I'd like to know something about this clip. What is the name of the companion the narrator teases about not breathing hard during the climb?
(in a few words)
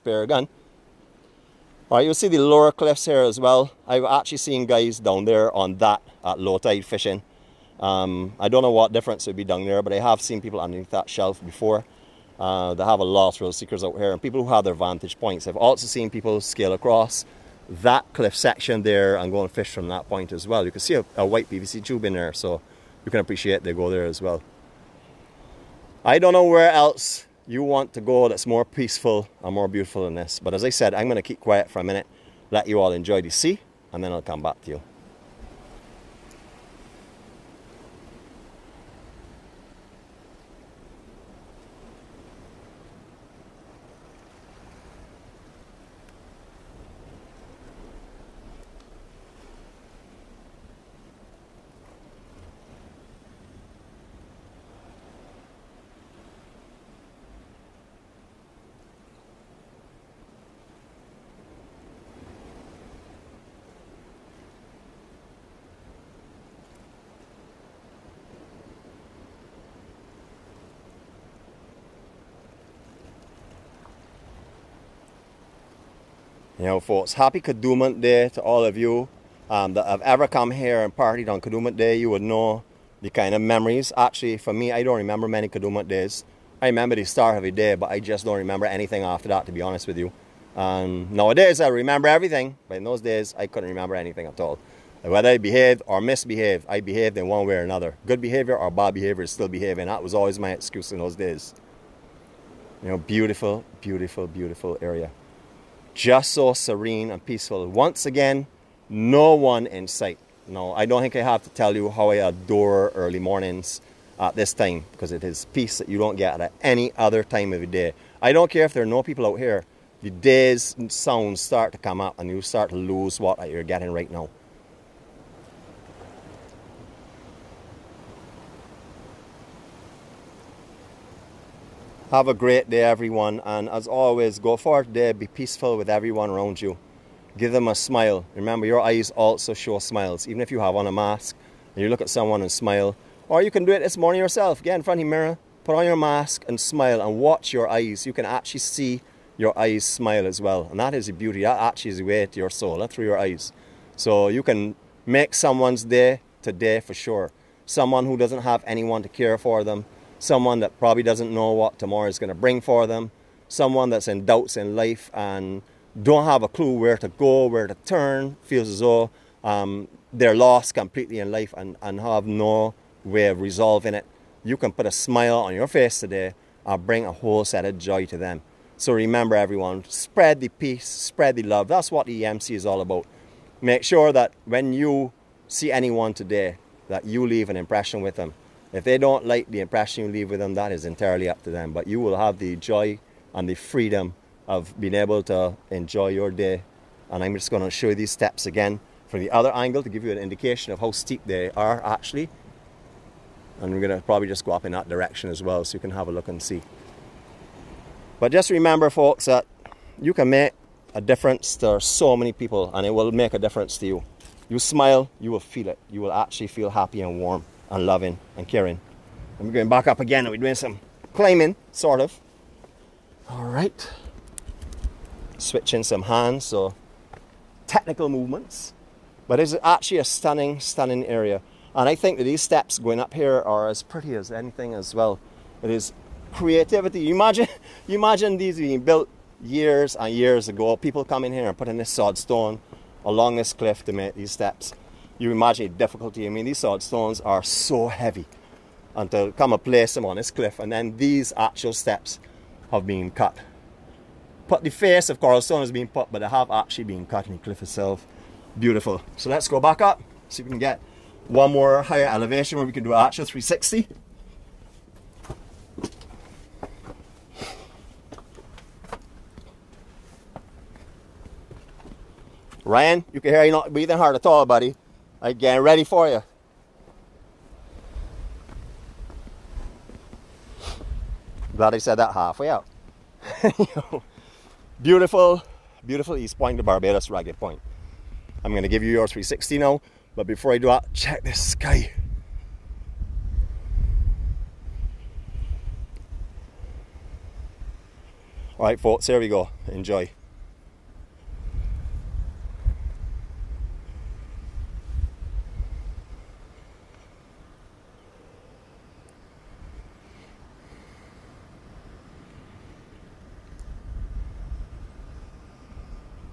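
Ryan.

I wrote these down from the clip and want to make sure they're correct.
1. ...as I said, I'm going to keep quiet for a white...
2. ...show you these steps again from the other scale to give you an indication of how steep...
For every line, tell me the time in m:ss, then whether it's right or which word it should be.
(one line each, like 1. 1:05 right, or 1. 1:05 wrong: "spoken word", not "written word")
1. 0:30 wrong: "minute", not "white"
2. 3:17 wrong: "angle", not "scale".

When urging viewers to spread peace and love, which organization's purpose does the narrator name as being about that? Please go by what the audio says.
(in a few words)
EMC.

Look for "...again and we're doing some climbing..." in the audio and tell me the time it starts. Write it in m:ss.
3:40.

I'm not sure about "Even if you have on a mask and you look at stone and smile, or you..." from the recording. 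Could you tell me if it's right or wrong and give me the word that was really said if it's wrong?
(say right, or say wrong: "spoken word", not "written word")
wrong: "someone", not "stone".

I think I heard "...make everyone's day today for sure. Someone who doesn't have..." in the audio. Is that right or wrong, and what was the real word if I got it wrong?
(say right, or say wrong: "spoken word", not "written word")
wrong: "someone", not "everyone".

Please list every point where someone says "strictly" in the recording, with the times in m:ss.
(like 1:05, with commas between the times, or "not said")
not said.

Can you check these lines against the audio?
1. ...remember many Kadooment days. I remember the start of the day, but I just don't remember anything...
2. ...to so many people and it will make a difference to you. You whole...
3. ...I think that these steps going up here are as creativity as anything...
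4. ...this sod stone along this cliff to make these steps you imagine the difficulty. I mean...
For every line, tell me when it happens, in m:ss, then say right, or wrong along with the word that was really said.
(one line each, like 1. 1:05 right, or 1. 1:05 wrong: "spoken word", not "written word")
1. 1:24 right
2. 3:31 wrong: "smile", not "whole"
3. 3:51 wrong: "pretty", not "creativity"
4. 4:01 right.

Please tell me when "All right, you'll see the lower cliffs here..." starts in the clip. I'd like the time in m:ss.
0:01.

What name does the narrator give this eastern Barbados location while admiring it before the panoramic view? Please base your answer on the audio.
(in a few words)
Ragged Point.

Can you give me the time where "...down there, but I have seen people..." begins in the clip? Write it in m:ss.
0:09.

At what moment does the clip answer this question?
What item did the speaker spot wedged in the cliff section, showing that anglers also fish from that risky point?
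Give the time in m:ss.
0:21.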